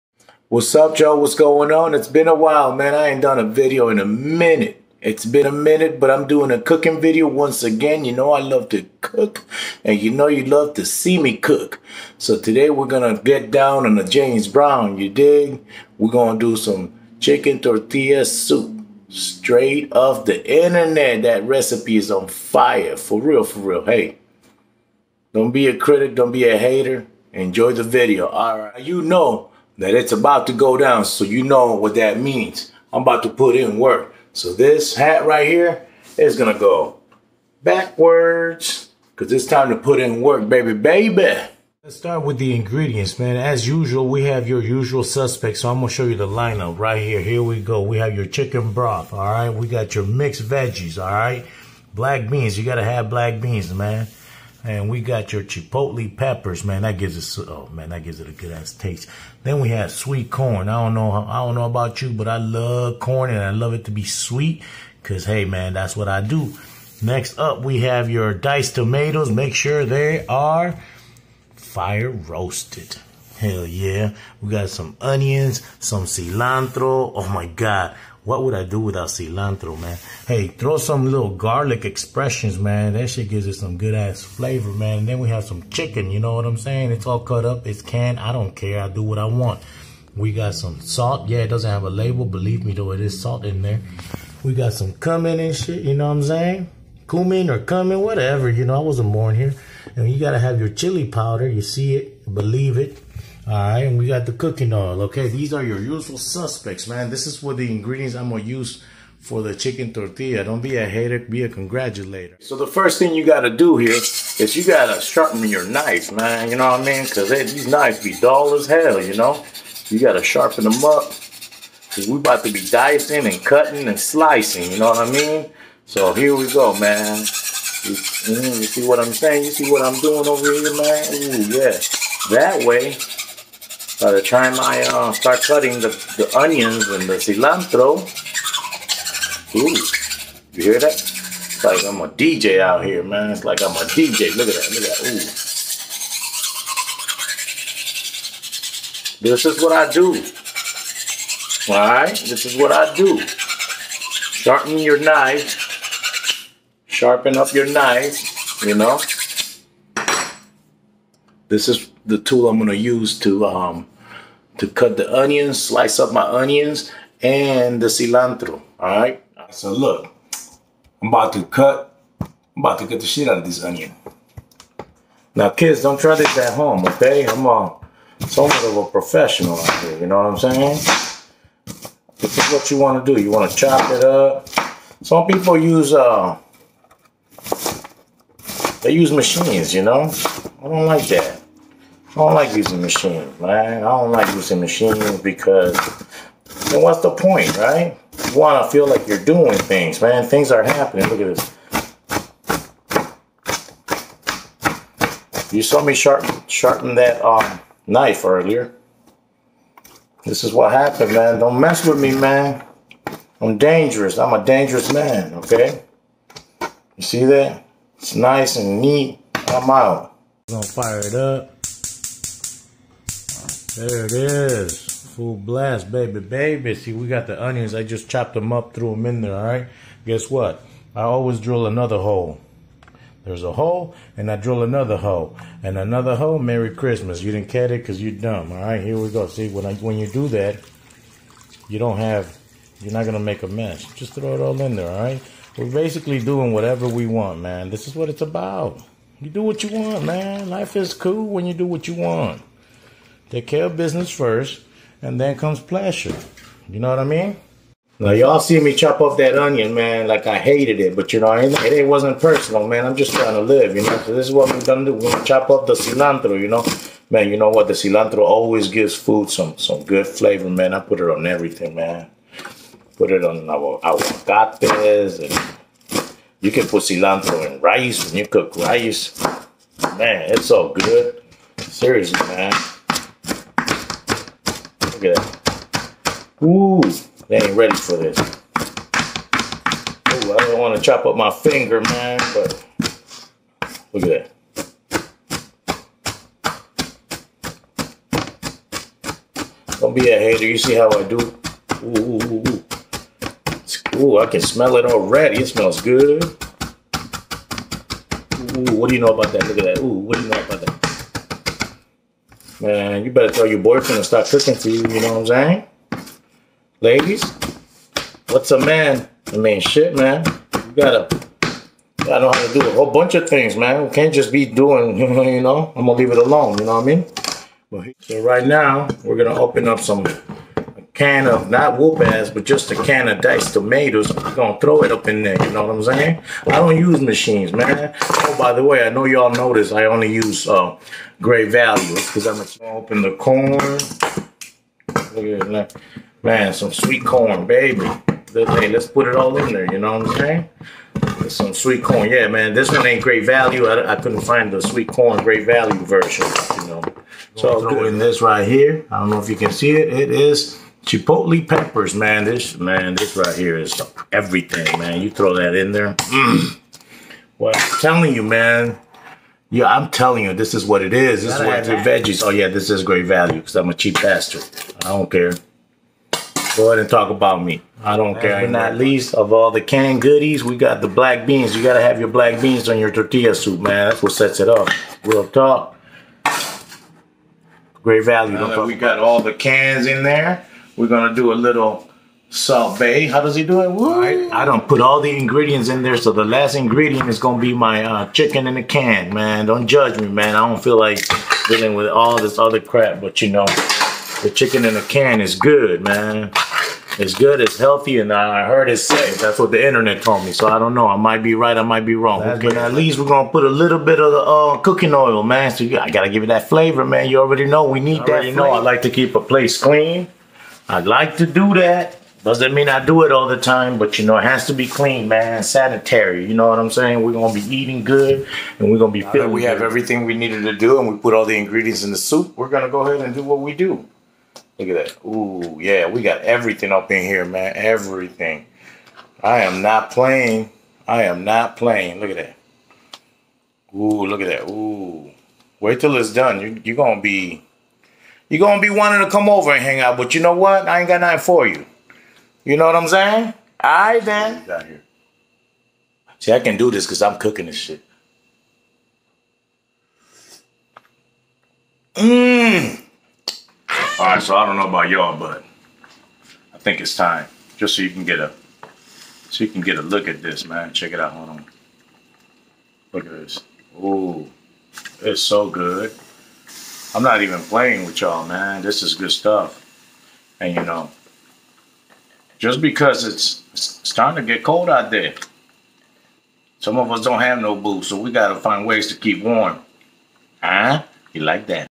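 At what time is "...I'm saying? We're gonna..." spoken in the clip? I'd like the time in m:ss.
7:06.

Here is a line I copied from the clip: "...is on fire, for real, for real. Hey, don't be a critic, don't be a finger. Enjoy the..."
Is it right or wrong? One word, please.
wrong.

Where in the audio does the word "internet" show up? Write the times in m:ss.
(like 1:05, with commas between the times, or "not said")
0:20, 6:49.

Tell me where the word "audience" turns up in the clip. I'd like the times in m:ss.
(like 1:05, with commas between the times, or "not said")
not said.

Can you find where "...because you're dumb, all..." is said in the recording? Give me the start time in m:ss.
3:57.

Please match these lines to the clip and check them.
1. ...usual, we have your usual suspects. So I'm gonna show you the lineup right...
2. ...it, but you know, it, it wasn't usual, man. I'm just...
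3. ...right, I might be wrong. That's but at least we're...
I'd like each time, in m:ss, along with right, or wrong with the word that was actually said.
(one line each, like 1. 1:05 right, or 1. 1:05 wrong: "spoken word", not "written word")
1. 0:43 right
2. 4:20 wrong: "personal", not "usual"
3. 6:51 right.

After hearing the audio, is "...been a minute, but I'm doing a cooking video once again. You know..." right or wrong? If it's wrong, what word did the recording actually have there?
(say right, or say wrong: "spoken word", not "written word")
right.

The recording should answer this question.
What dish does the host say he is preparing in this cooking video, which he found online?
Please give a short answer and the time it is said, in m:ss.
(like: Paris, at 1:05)
Chicken tortilla soup, at 0:17.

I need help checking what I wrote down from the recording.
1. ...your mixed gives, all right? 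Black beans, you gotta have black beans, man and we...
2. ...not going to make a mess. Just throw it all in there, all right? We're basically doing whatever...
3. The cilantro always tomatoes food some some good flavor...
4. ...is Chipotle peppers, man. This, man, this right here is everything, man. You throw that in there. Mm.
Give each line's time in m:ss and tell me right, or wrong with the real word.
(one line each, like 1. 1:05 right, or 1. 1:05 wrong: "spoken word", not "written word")
1. 0:49 wrong: "veggies", not "gives"
2. 4:02 right
3. 4:27 wrong: "gives", not "tomatoes"
4. 6:00 right.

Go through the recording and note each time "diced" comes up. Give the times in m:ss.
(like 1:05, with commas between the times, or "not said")
1:08, 5:33.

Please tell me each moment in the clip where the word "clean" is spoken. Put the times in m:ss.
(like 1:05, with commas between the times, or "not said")
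6:59, 7:04.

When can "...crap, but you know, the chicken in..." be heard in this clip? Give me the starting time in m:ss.
6:42.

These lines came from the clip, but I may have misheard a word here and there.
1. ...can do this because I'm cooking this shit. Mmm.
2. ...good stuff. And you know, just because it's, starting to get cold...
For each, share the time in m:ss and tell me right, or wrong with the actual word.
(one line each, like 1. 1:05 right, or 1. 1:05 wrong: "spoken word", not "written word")
1. 7:36 right
2. 7:58 right.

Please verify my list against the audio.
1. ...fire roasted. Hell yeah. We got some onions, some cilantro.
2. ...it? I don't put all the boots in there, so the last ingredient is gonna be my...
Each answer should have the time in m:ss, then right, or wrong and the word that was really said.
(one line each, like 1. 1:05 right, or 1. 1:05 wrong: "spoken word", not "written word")
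1. 1:11 right
2. 6:33 wrong: "ingredients", not "boots".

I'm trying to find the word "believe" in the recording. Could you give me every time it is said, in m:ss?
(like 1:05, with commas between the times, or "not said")
1:32, 1:42.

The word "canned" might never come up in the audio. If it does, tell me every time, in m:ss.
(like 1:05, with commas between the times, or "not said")
1:27, 6:19.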